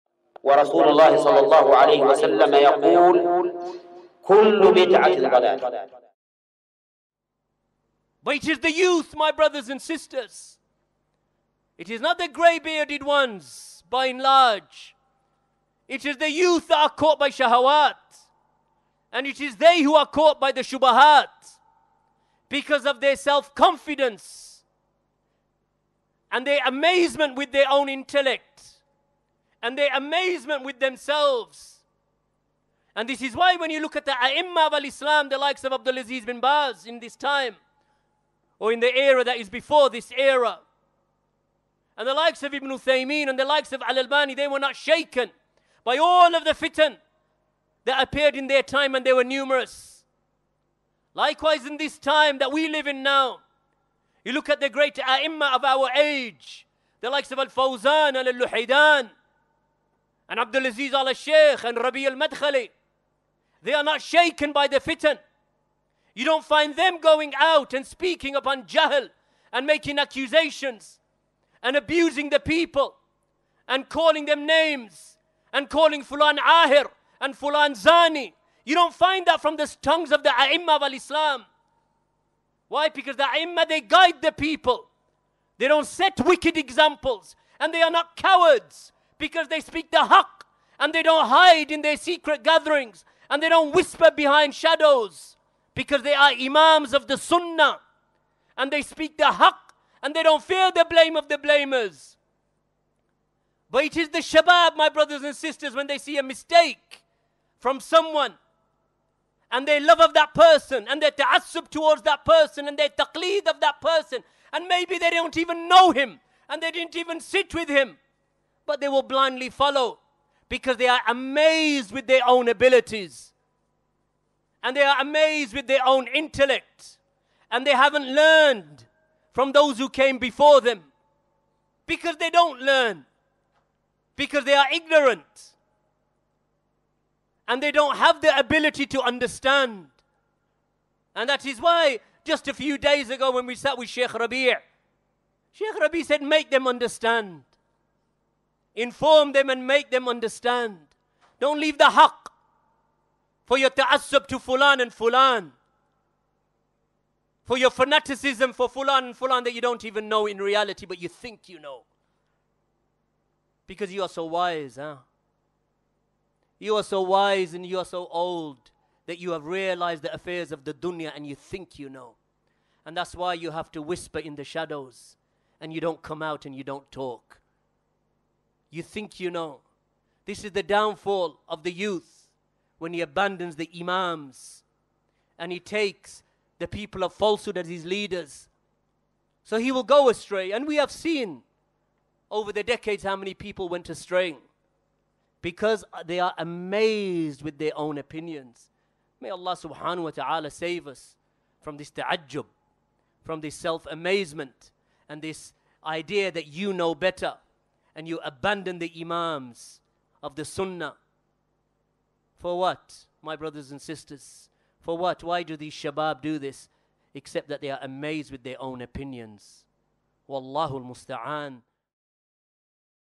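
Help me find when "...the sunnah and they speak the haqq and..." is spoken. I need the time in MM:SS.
01:37.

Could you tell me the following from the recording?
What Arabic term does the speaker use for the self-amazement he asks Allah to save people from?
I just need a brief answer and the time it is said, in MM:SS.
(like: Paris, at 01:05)
ta'ajjub, at 03:21.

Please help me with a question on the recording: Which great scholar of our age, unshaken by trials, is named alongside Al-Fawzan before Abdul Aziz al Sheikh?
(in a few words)
Al-Luhaydan.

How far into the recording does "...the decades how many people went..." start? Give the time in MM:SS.
03:12.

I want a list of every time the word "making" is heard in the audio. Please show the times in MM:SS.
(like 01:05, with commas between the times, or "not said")
01:09.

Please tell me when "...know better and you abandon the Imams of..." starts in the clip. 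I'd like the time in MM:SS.
03:26.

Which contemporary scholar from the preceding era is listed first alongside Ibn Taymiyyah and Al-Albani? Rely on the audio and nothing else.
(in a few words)
Abdul Aziz bin Baz.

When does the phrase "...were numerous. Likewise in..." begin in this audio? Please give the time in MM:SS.
00:49.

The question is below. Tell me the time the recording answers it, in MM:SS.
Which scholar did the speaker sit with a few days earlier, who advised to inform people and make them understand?
02:25.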